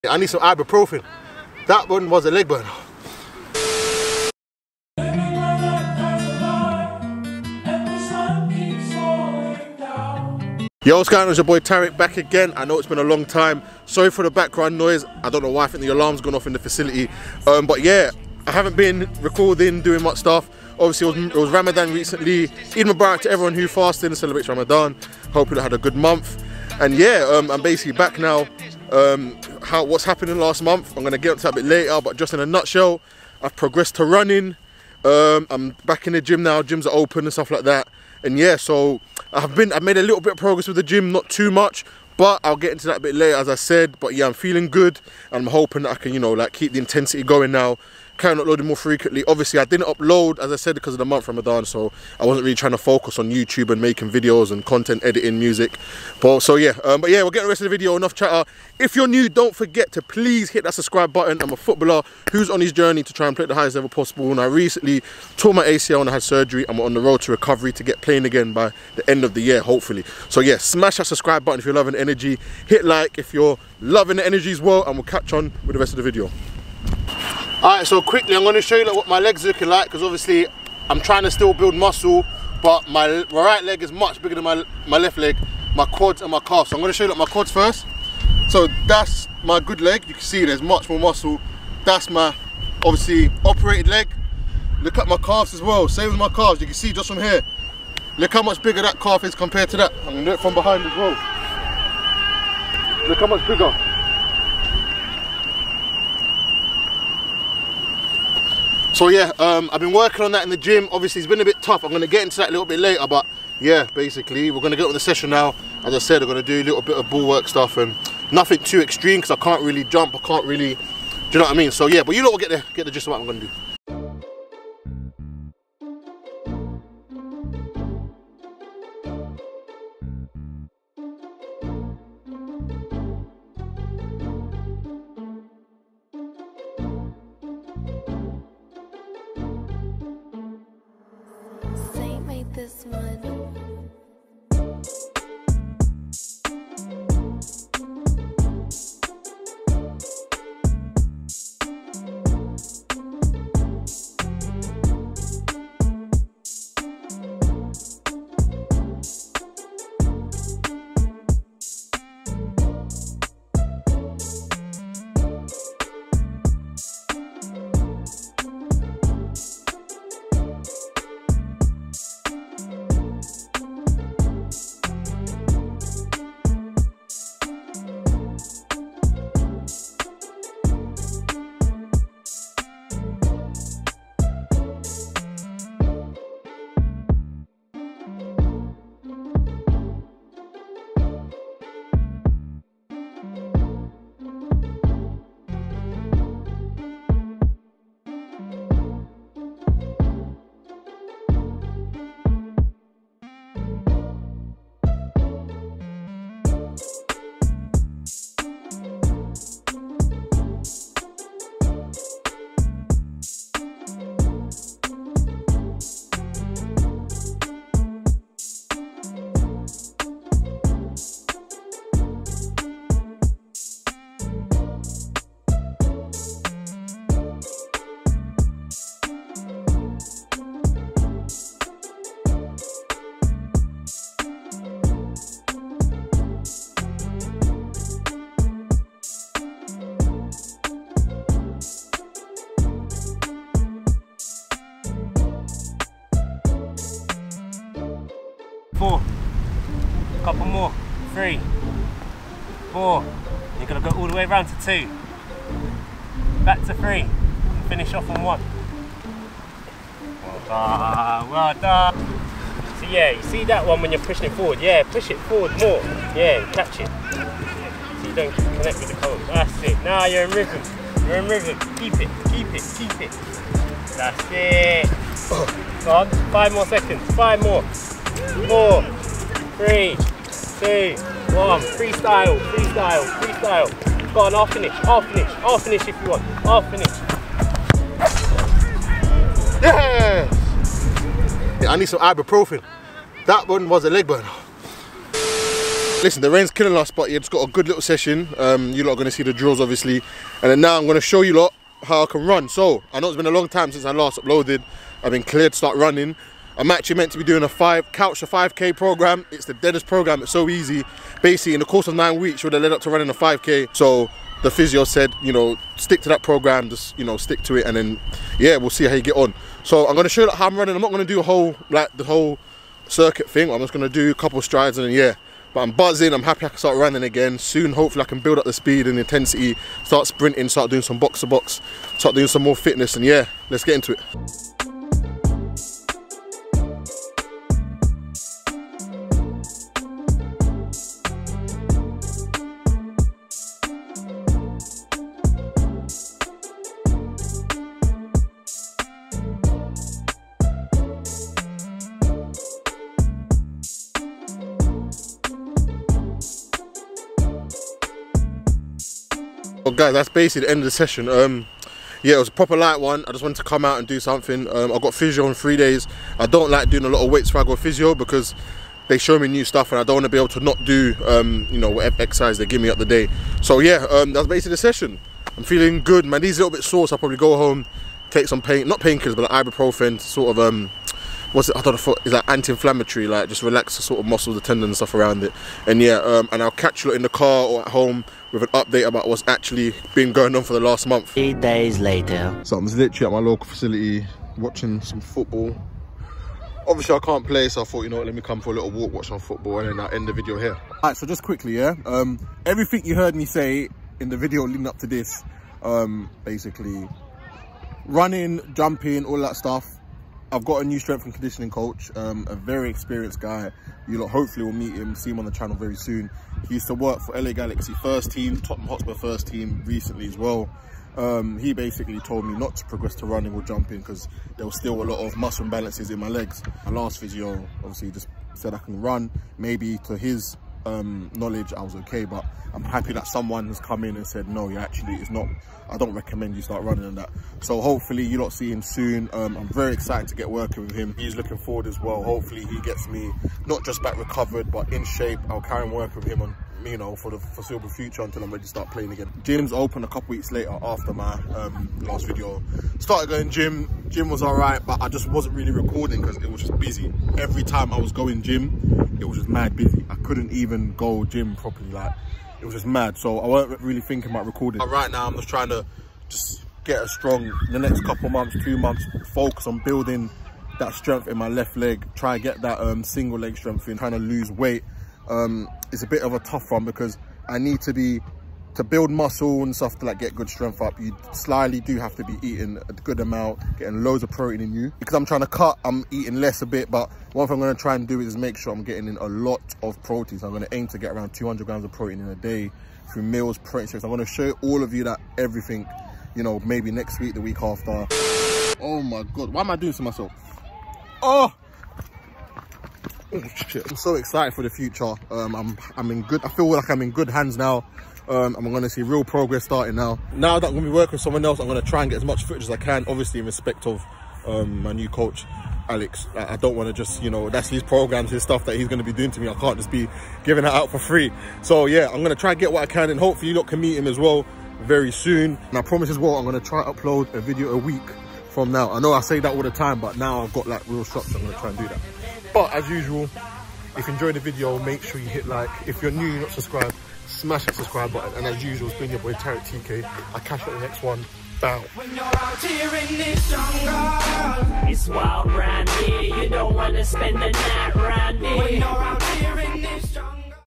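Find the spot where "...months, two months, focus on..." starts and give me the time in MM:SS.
07:48.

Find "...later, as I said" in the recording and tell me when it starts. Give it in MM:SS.
00:43.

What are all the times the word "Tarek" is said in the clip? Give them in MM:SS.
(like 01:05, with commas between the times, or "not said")
00:11, 08:59.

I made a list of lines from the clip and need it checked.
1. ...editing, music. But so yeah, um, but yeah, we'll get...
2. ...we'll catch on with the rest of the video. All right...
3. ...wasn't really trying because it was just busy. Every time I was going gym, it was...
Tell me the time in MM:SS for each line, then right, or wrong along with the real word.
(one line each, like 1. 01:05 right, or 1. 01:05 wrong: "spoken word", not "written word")
1. 00:55 right
2. 01:14 right
3. 07:35 wrong: "recording", not "trying".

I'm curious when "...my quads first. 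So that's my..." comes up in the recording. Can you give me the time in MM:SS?
01:27.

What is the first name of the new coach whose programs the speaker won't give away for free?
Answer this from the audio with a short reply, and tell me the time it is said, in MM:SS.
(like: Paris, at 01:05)
Alex, at 08:35.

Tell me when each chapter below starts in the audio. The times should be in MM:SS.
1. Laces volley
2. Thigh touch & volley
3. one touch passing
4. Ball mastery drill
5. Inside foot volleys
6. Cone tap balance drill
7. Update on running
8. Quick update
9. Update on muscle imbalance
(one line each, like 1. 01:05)
1. 02:40
2. 03:23
3. 03:01
4. 04:22
5. 02:03
6. 03:55
7. 04:55
8. 00:10
9. 01:17.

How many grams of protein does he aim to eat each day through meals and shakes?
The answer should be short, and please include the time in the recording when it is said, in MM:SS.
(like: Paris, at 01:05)
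200 grams, at 08:11.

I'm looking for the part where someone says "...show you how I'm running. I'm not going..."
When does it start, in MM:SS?
05:20.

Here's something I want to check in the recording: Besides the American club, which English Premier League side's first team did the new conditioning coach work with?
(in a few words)
Tottenham Hotspur.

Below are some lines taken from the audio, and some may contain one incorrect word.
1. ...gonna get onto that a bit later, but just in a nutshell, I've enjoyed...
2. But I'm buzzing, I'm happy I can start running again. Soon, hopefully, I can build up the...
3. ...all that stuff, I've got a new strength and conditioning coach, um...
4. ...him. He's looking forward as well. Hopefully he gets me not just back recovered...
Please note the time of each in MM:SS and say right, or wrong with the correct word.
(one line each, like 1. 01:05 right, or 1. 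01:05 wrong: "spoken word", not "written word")
1. 00:31 wrong: "progressed", not "enjoyed"
2. 05:25 right
3. 06:49 right
4. 07:20 right.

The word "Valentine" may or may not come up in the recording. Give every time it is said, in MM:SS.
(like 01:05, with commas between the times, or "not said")
not said.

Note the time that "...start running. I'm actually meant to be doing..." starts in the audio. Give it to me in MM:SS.
05:05.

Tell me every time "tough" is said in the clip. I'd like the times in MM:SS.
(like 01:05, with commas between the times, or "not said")
01:51, 07:56.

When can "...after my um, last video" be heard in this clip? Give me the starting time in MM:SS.
07:30.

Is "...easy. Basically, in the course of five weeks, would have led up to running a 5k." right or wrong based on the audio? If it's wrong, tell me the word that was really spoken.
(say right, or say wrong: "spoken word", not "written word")
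wrong: "nine", not "five".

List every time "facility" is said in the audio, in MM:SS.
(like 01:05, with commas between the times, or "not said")
00:16, 06:33.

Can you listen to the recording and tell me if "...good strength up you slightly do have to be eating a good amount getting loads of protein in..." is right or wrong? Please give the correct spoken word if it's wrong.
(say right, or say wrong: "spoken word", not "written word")
right.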